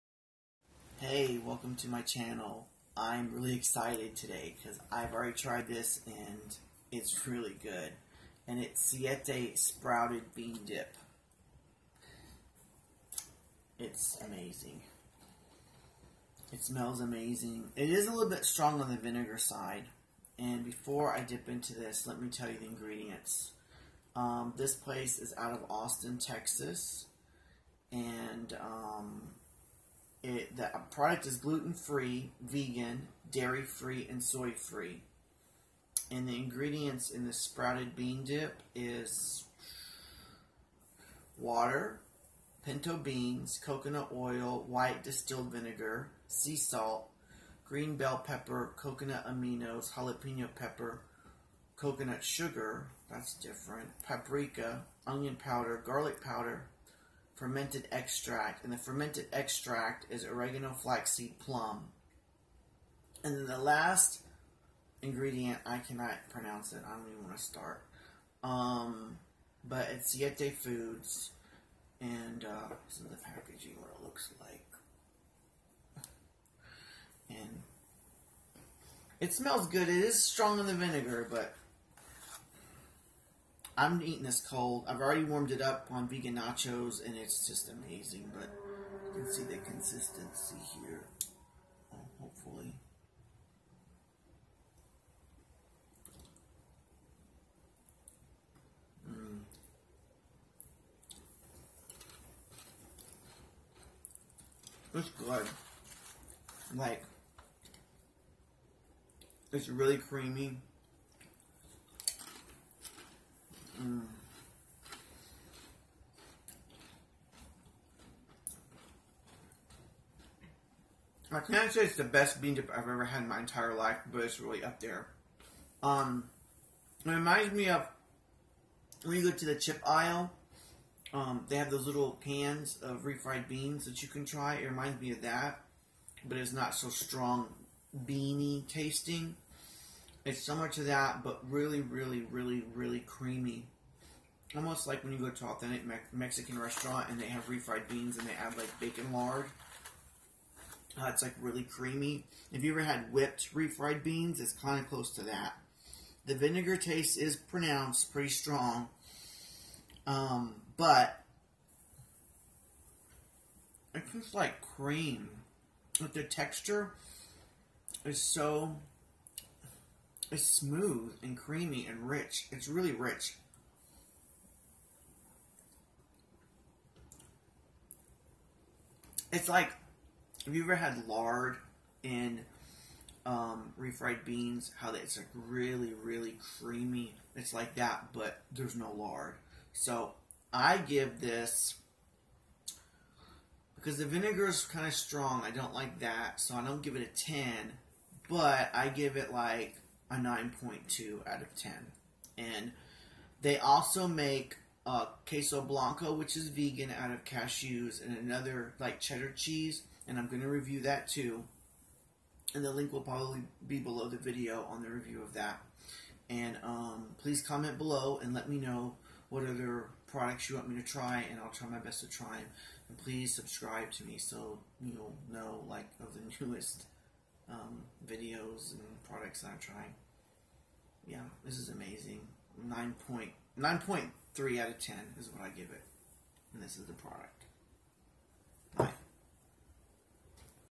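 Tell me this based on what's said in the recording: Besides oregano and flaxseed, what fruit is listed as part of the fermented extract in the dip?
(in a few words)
plum.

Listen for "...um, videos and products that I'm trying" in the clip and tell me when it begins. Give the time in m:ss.
3:47.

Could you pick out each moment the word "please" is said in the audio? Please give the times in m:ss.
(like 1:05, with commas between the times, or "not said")
3:37, 3:42.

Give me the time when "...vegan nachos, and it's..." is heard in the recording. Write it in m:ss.
1:26.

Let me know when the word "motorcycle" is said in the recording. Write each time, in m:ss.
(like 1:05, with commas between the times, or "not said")
not said.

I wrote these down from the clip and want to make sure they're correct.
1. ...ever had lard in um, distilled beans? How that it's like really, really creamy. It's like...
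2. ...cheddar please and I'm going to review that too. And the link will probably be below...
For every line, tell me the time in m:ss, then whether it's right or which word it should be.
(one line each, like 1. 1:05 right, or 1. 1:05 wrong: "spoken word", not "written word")
1. 3:00 wrong: "refried", not "distilled"
2. 3:28 wrong: "cheese", not "please".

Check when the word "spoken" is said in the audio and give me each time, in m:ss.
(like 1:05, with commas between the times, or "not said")
not said.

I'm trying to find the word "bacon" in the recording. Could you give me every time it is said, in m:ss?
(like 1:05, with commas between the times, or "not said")
2:28.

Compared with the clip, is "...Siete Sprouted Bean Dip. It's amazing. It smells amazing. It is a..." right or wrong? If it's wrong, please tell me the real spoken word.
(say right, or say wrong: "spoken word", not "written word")
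right.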